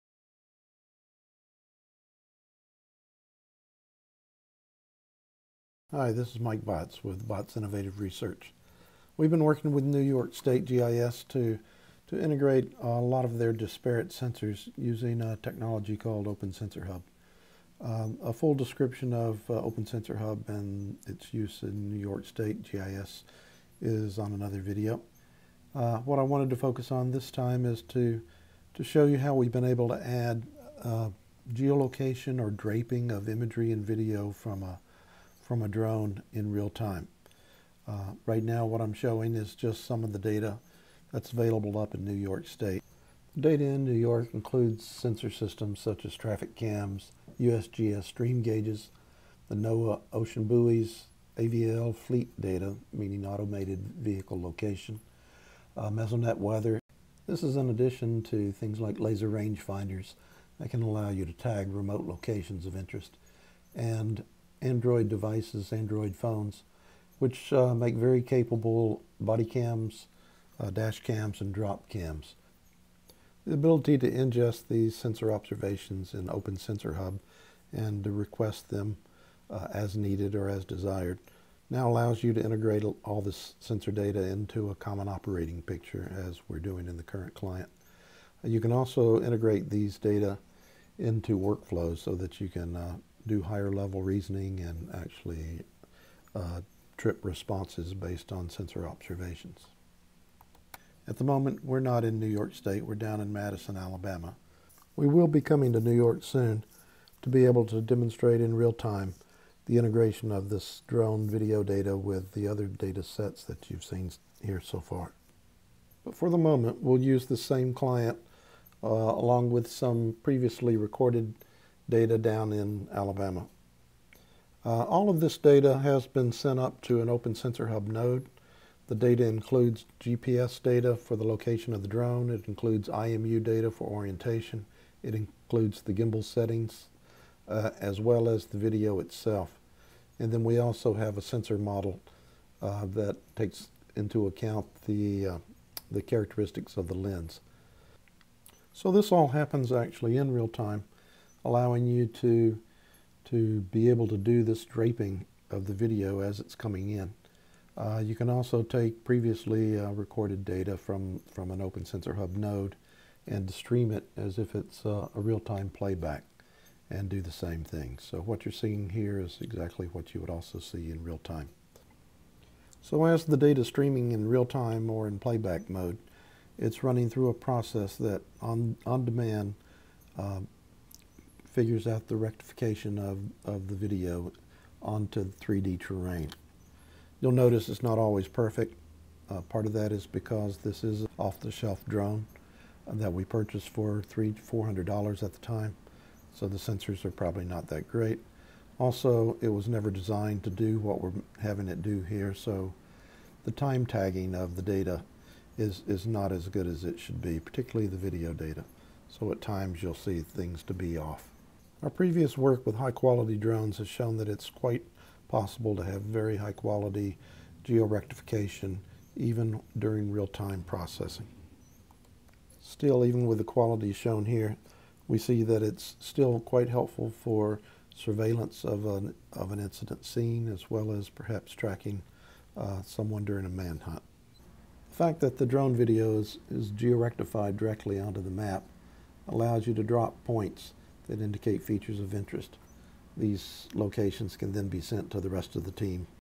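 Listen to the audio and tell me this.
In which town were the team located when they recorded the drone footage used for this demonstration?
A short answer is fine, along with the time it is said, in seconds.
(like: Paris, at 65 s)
Madison, Alabama, at 103 s.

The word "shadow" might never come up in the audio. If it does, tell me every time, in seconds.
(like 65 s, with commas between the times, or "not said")
not said.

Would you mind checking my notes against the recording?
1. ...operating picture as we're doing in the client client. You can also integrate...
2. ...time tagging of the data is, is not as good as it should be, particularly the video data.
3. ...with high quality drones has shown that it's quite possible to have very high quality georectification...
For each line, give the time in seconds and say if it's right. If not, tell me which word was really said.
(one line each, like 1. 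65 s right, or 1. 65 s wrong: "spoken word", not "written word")
1. 85 s wrong: "current", not "client"
2. 203 s right
3. 212 s right.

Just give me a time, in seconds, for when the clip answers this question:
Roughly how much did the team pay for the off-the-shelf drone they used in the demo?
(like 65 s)
194 s.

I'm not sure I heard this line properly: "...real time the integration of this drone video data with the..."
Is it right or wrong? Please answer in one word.
right.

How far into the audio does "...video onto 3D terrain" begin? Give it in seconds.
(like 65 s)
183 s.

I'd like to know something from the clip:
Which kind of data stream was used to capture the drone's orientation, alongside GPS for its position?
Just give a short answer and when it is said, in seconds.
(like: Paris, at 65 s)
IMU data, at 132 s.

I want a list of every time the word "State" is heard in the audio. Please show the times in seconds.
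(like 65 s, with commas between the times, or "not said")
10 s, 22 s, 42 s, 102 s.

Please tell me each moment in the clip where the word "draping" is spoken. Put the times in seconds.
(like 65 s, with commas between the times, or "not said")
32 s, 154 s.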